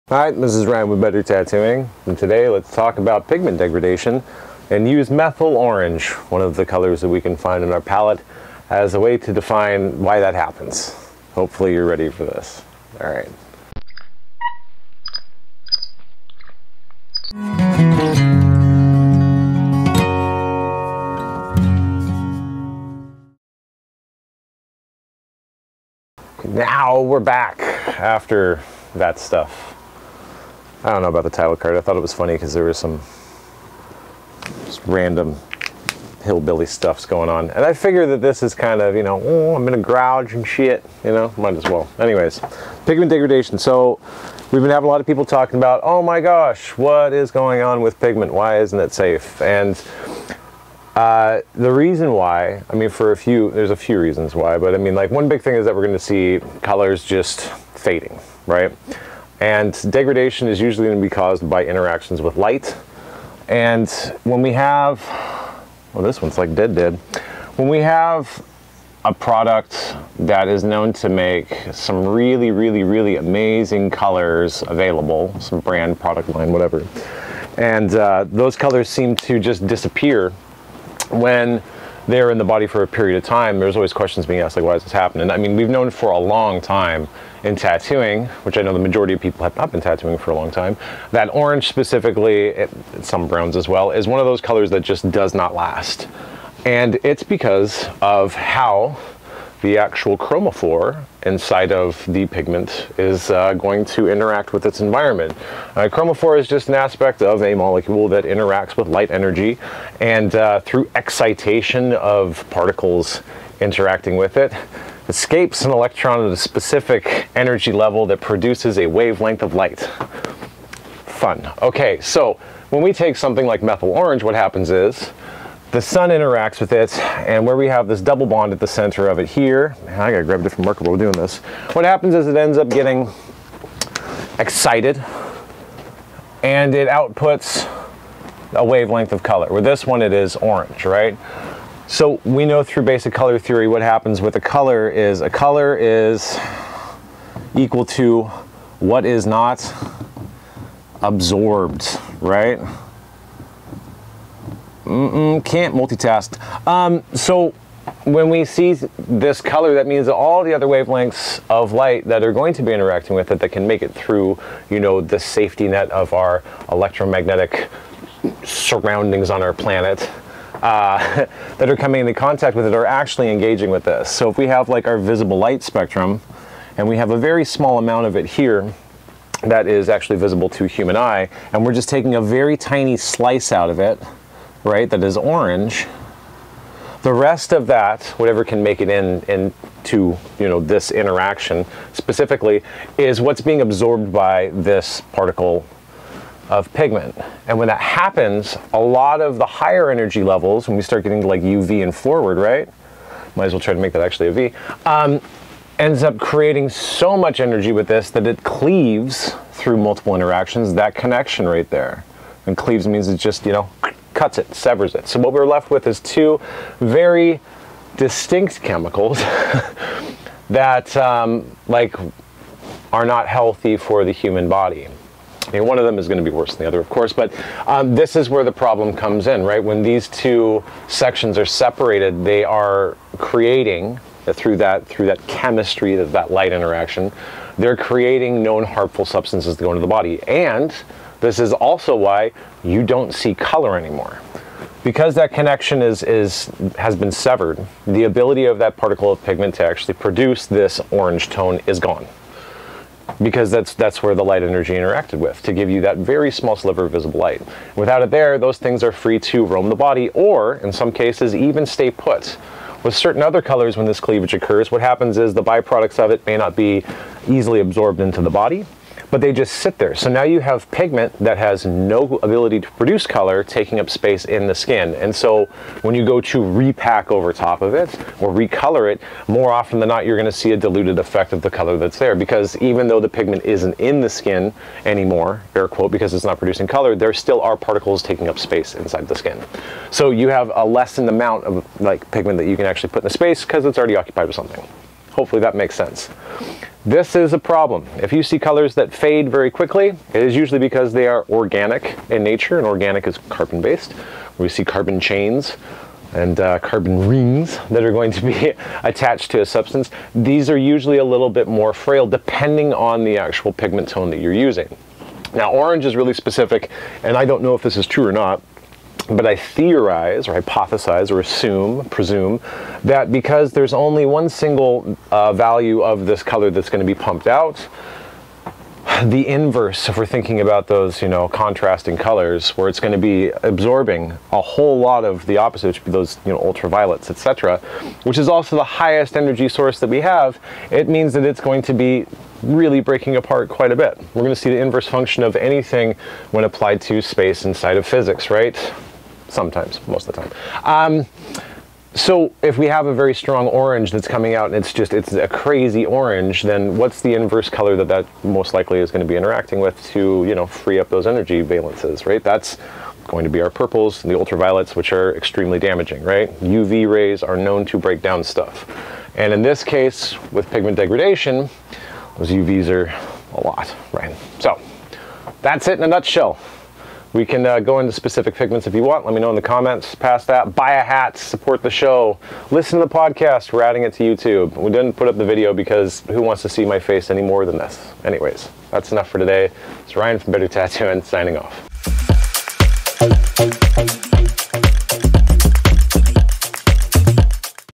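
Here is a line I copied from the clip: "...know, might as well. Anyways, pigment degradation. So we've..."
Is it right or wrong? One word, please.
right.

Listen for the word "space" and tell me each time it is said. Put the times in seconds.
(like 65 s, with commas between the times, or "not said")
273 s, 288 s, 293 s, 347 s.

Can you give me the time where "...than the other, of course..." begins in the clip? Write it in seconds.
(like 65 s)
226 s.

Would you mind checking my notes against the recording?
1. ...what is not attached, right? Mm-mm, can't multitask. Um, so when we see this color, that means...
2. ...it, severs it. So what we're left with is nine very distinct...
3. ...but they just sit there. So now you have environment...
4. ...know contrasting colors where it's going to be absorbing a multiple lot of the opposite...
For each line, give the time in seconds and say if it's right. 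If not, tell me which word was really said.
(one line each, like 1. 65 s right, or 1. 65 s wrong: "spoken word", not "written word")
1. 148 s wrong: "absorbed", not "attached"
2. 214 s wrong: "two", not "nine"
3. 269 s wrong: "pigment", not "environment"
4. 331 s wrong: "whole", not "multiple".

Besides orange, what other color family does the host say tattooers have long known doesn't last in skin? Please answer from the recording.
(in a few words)
Browns.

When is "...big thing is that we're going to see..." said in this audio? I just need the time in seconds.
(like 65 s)
55 s.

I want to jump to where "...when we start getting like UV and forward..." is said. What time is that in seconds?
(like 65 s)
200 s.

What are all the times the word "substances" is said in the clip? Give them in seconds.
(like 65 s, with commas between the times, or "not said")
239 s, 309 s.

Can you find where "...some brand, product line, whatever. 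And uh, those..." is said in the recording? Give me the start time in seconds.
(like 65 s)
75 s.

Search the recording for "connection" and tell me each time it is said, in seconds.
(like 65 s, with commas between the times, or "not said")
210 s, 245 s.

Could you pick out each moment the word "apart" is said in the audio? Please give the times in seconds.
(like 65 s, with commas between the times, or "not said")
343 s.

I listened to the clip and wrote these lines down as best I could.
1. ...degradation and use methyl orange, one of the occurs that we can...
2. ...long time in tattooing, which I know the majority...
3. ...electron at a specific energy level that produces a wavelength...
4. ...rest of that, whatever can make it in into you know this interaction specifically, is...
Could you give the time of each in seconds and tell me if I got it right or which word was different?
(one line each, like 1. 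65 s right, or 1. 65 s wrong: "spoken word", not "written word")
1. 3 s wrong: "colors", not "occurs"
2. 86 s right
3. 115 s right
4. 187 s right.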